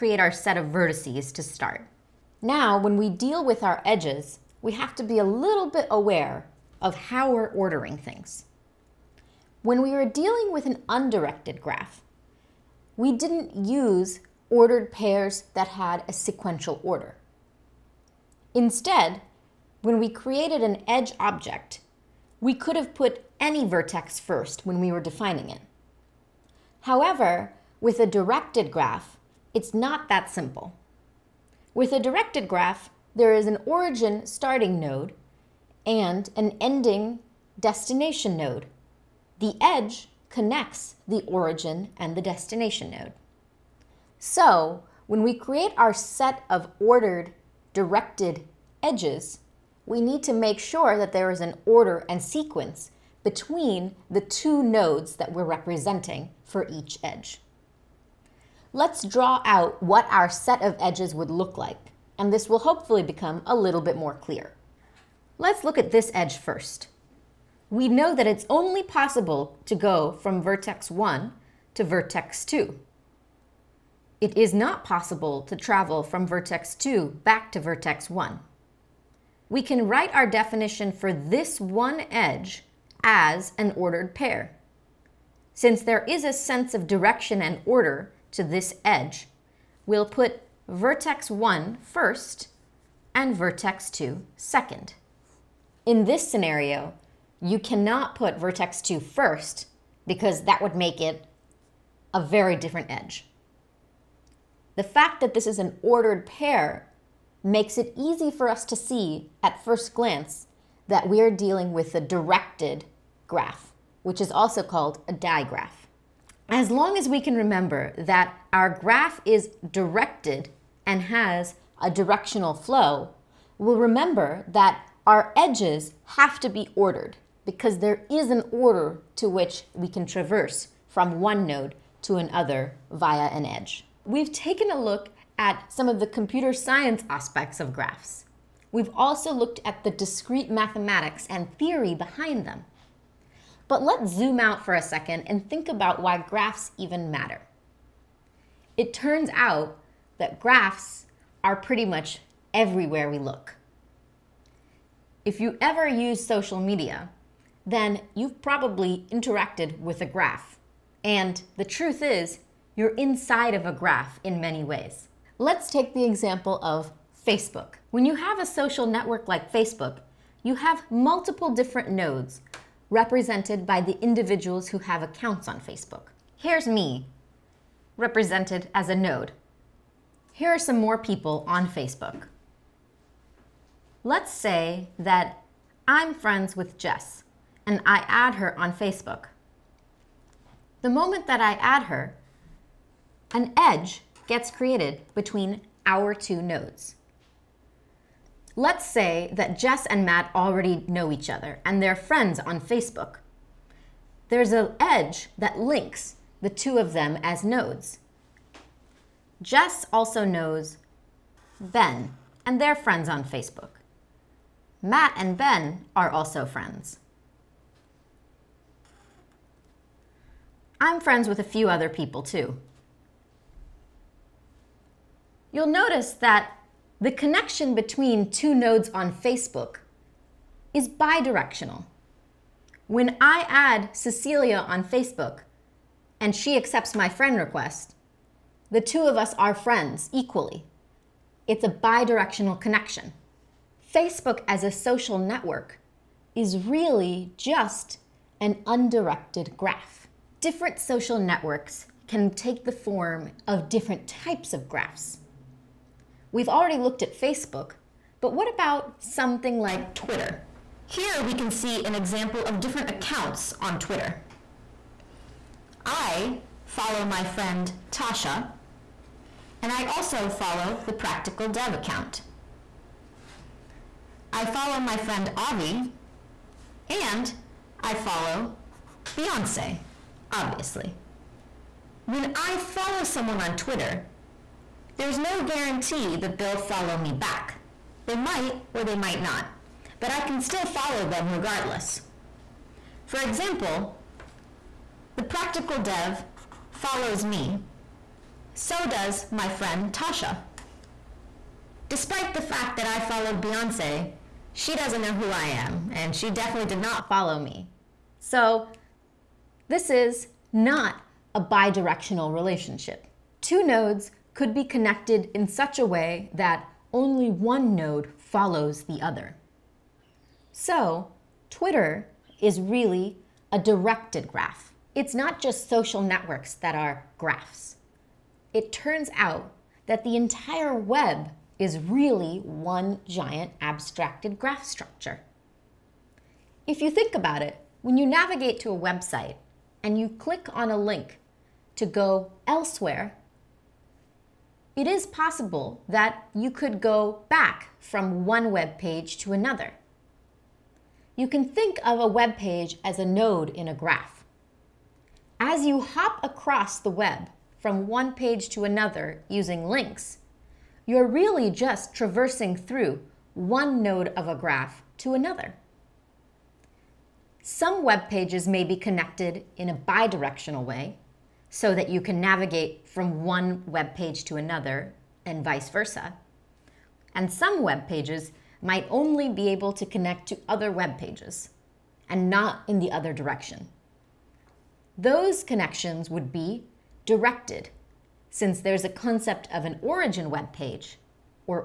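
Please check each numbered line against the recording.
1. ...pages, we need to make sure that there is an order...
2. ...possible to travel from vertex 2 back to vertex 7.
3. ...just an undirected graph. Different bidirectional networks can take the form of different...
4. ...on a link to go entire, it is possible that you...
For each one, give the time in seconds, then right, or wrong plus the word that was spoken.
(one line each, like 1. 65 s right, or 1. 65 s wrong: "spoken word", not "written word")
1. 48 s wrong: "edges", not "pages"
2. 74 s wrong: "1", not "7"
3. 247 s wrong: "social", not "bidirectional"
4. 340 s wrong: "elsewhere", not "entire".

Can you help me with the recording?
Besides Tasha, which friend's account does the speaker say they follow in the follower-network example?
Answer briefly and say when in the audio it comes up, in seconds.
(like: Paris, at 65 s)
Avi, at 275 s.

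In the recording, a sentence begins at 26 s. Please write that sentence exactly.
However, with a directed graph, it's not that simple.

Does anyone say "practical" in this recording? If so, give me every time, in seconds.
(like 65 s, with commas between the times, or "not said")
270 s, 295 s.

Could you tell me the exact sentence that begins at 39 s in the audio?
The edge connects the origin and the destination node.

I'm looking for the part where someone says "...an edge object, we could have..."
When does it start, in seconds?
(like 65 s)
20 s.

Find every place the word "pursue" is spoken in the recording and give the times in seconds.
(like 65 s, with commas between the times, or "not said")
not said.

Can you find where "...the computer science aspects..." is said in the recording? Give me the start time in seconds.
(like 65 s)
135 s.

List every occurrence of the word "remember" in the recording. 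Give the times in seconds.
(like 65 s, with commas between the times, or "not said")
117 s, 123 s.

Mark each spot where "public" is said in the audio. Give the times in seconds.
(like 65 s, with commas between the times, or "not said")
not said.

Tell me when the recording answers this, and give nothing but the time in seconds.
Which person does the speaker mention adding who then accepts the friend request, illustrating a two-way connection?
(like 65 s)
233 s.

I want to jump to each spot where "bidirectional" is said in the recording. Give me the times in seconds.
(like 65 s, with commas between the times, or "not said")
230 s, 241 s, 311 s, 369 s.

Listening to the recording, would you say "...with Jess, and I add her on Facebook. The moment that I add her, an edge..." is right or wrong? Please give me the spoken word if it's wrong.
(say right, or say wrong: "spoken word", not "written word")
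right.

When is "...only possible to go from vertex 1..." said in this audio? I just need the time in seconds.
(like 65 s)
68 s.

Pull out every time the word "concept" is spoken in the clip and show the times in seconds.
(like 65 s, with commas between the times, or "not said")
388 s.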